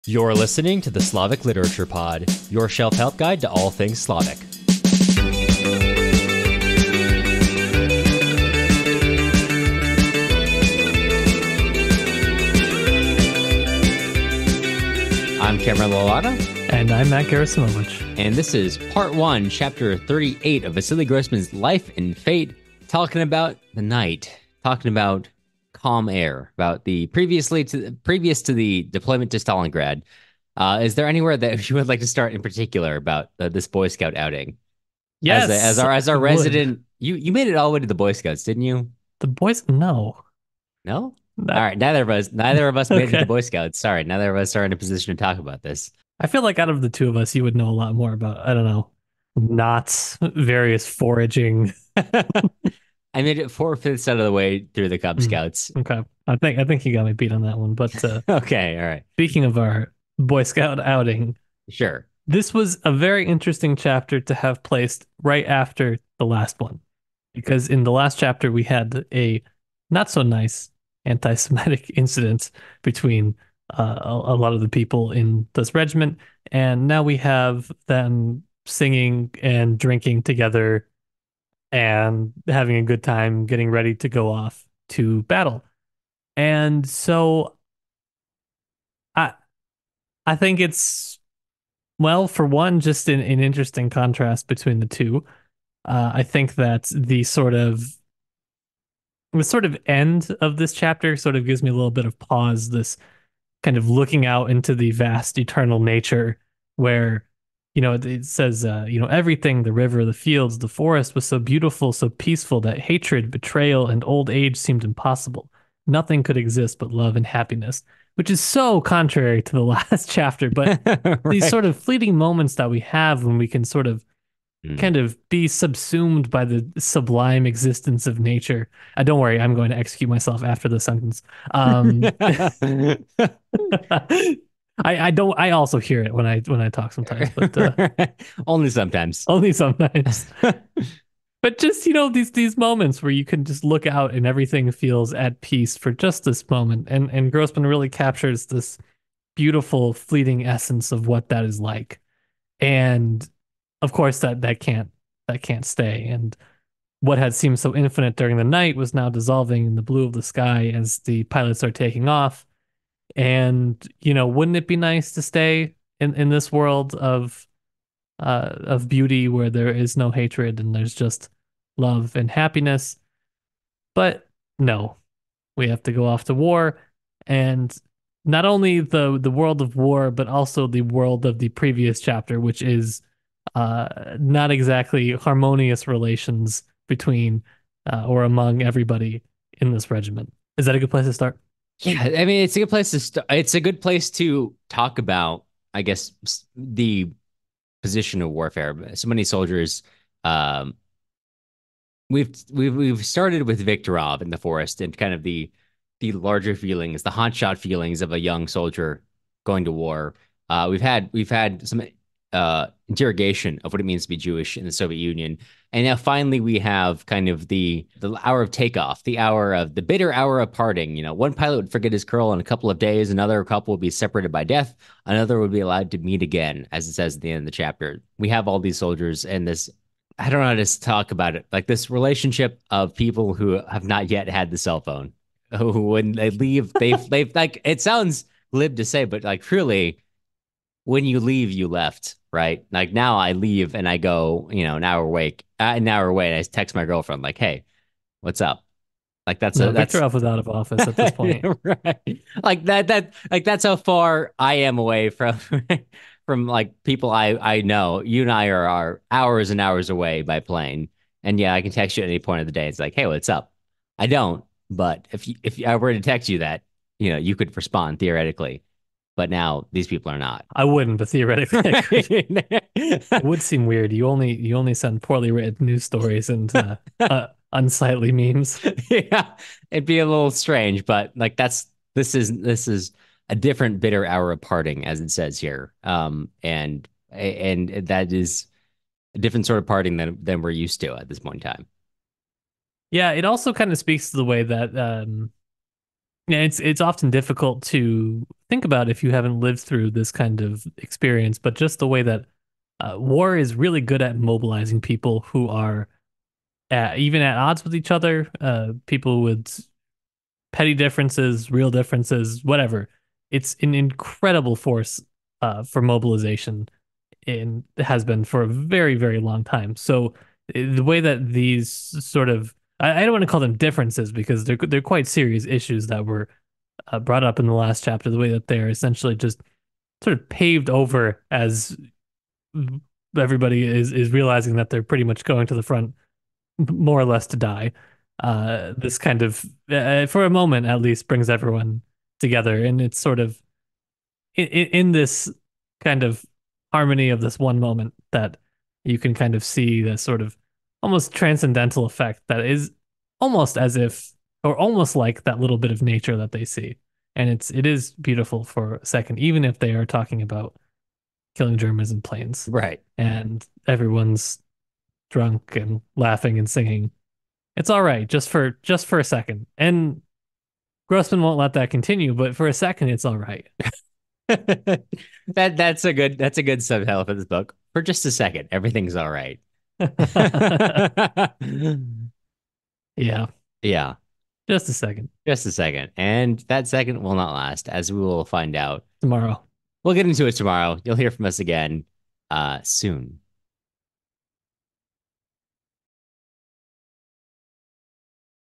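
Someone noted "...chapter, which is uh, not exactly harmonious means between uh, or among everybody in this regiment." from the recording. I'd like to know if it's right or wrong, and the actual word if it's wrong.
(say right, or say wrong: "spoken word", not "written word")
wrong: "relations", not "means".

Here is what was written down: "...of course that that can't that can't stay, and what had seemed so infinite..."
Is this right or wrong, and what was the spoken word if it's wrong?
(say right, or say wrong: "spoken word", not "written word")
right.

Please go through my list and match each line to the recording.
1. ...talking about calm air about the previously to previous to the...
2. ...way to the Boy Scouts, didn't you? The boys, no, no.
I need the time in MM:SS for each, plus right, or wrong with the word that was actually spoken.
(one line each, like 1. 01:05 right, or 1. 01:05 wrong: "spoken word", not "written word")
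1. 00:24 right
2. 00:37 right.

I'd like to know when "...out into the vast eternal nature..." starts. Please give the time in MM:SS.
01:44.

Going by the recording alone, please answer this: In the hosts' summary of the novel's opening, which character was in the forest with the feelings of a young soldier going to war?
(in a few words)
Viktorov.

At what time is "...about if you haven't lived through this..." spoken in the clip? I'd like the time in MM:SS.
04:58.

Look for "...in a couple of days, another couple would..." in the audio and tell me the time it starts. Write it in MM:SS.
03:42.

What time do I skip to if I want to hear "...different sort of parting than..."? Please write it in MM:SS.
04:49.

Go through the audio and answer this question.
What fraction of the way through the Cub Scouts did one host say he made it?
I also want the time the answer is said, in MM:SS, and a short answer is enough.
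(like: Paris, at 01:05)
four fifths, at 00:53.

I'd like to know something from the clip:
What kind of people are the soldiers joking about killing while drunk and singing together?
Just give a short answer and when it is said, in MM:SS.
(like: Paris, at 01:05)
Germans, at 06:01.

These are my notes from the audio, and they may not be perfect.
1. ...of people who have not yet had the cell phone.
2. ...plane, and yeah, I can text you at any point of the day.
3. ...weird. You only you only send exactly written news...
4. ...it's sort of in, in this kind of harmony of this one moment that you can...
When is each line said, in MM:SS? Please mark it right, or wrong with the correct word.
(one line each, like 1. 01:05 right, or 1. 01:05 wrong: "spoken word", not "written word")
1. 03:52 right
2. 04:20 right
3. 04:33 wrong: "poorly", not "exactly"
4. 05:42 right.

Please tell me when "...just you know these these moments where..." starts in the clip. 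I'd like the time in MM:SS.
02:21.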